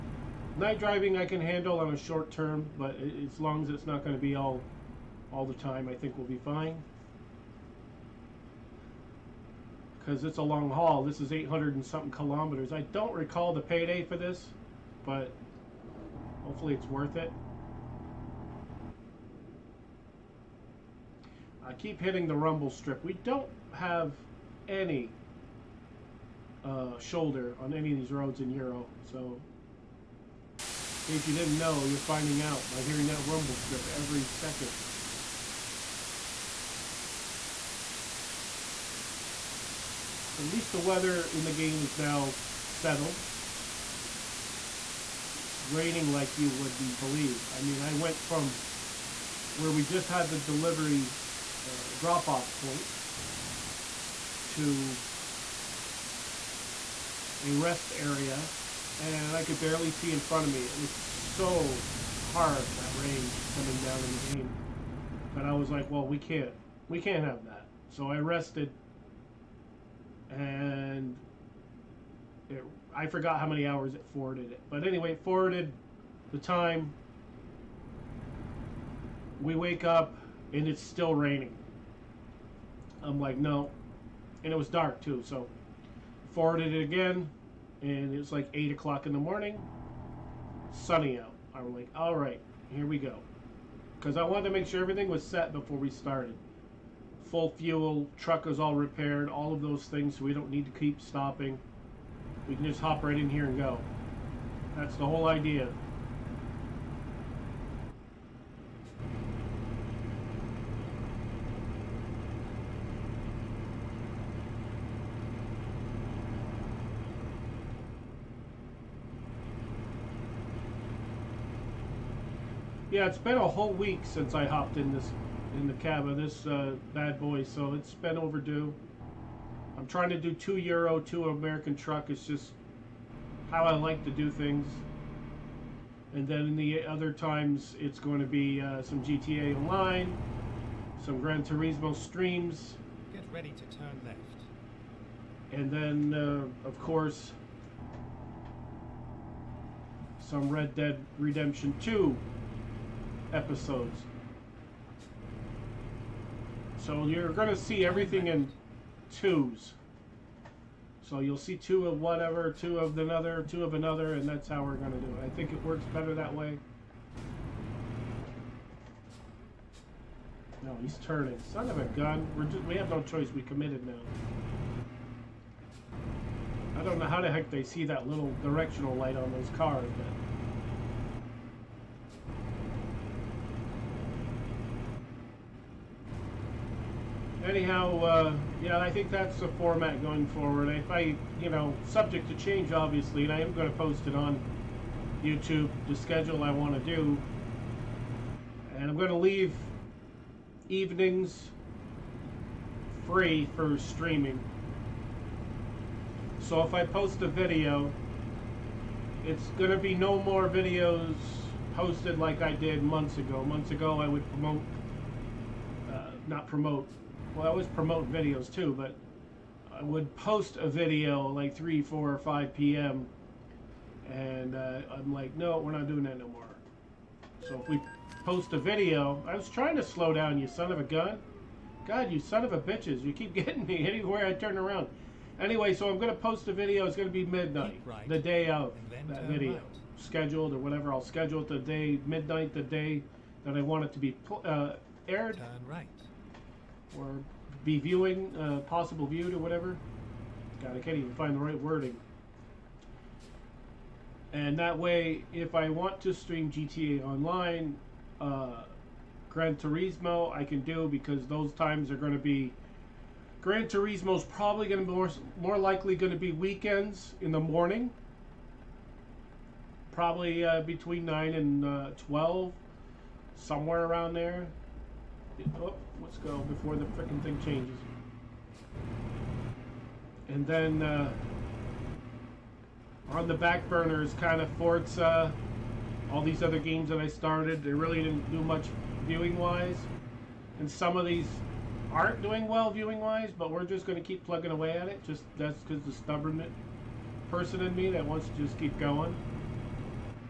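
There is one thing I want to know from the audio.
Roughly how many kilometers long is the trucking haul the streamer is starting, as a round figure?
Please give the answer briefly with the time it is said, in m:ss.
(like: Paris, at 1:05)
800, at 0:11.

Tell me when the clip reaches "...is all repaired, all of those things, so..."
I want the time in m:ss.
1:38.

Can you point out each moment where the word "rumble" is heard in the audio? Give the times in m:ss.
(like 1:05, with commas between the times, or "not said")
0:22, 0:33.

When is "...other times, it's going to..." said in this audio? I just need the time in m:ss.
2:16.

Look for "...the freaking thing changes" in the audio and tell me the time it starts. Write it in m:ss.
4:36.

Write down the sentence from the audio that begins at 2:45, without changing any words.
I think it works better that way.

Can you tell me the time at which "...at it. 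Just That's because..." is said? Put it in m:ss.
4:54.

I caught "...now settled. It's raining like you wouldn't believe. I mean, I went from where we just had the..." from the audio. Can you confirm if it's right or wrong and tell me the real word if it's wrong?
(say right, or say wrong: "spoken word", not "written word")
right.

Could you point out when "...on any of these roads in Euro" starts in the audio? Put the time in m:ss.
0:27.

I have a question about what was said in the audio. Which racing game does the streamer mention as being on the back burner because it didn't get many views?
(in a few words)
Forza.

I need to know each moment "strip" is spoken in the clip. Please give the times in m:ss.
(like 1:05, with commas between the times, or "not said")
0:22, 0:33.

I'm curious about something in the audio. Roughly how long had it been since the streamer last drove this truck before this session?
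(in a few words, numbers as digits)
a whole week.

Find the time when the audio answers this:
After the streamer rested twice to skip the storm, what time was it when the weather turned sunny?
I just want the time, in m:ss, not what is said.
1:28.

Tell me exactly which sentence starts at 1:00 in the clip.
It was so hard that rain coming down in the game.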